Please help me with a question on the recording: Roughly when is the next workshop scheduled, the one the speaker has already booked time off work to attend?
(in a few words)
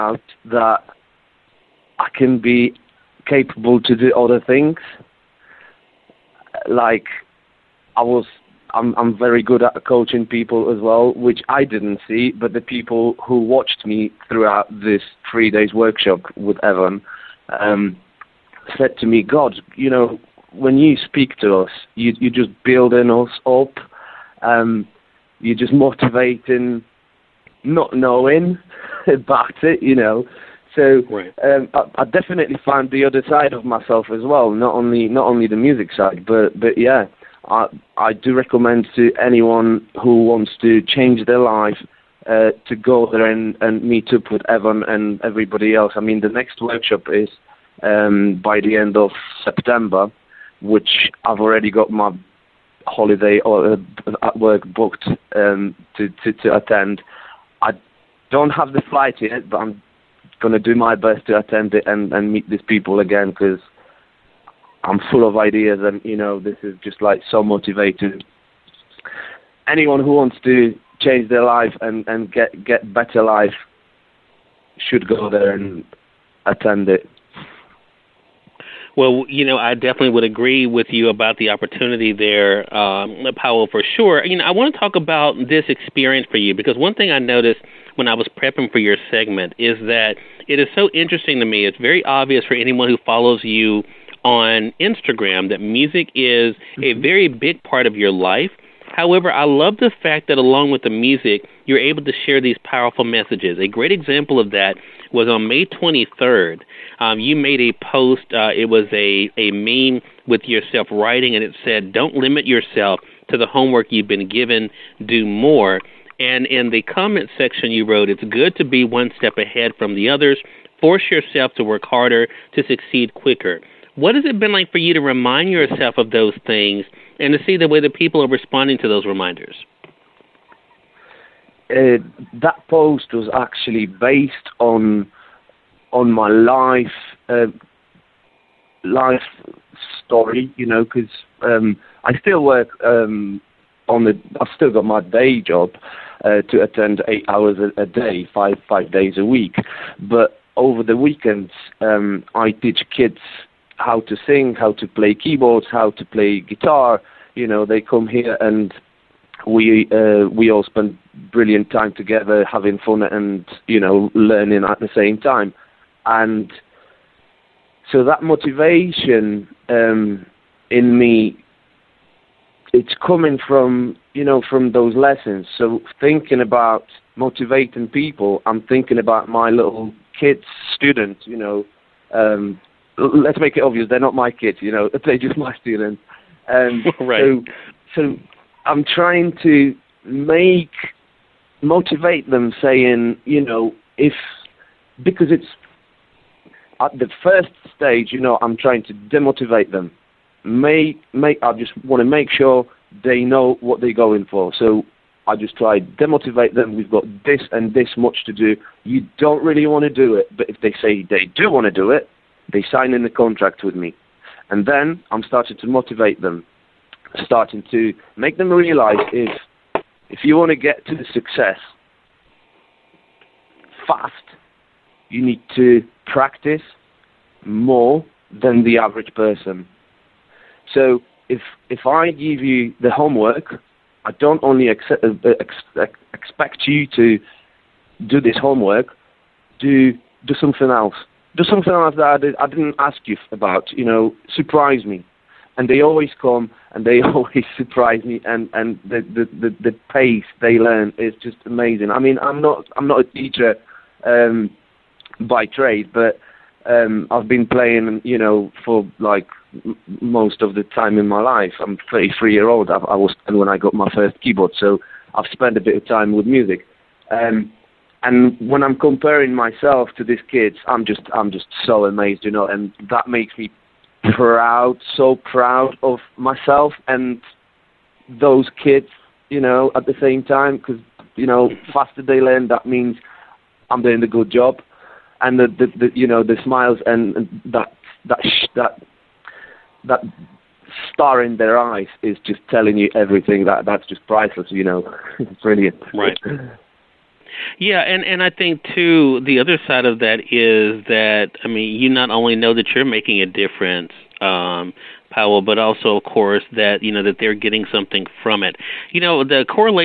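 End of September.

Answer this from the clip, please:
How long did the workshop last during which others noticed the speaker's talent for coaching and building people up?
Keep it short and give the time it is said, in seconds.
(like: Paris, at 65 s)
3 days, at 15 s.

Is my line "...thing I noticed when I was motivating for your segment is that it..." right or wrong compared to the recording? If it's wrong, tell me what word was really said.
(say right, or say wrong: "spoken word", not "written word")
wrong: "prepping", not "motivating".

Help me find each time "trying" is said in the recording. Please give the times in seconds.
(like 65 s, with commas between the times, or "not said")
188 s, 198 s.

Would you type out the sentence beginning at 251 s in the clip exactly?
I mean, I'm not I'm not a teacher um, by trade, but um, I've been playing.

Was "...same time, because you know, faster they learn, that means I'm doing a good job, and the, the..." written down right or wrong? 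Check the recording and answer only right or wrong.
right.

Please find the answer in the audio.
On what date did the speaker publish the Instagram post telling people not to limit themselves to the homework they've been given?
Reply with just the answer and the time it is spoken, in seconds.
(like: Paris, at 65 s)
May 23rd, at 105 s.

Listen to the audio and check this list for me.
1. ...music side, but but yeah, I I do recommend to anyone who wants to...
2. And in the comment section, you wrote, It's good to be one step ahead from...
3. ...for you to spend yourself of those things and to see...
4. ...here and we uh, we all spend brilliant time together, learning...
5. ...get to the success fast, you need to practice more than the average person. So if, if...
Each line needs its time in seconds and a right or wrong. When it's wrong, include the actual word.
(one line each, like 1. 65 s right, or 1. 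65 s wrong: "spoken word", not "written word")
1. 35 s right
2. 116 s right
3. 124 s wrong: "remind", not "spend"
4. 158 s wrong: "having", not "learning"
5. 220 s right.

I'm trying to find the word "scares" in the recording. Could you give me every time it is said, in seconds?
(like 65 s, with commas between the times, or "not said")
not said.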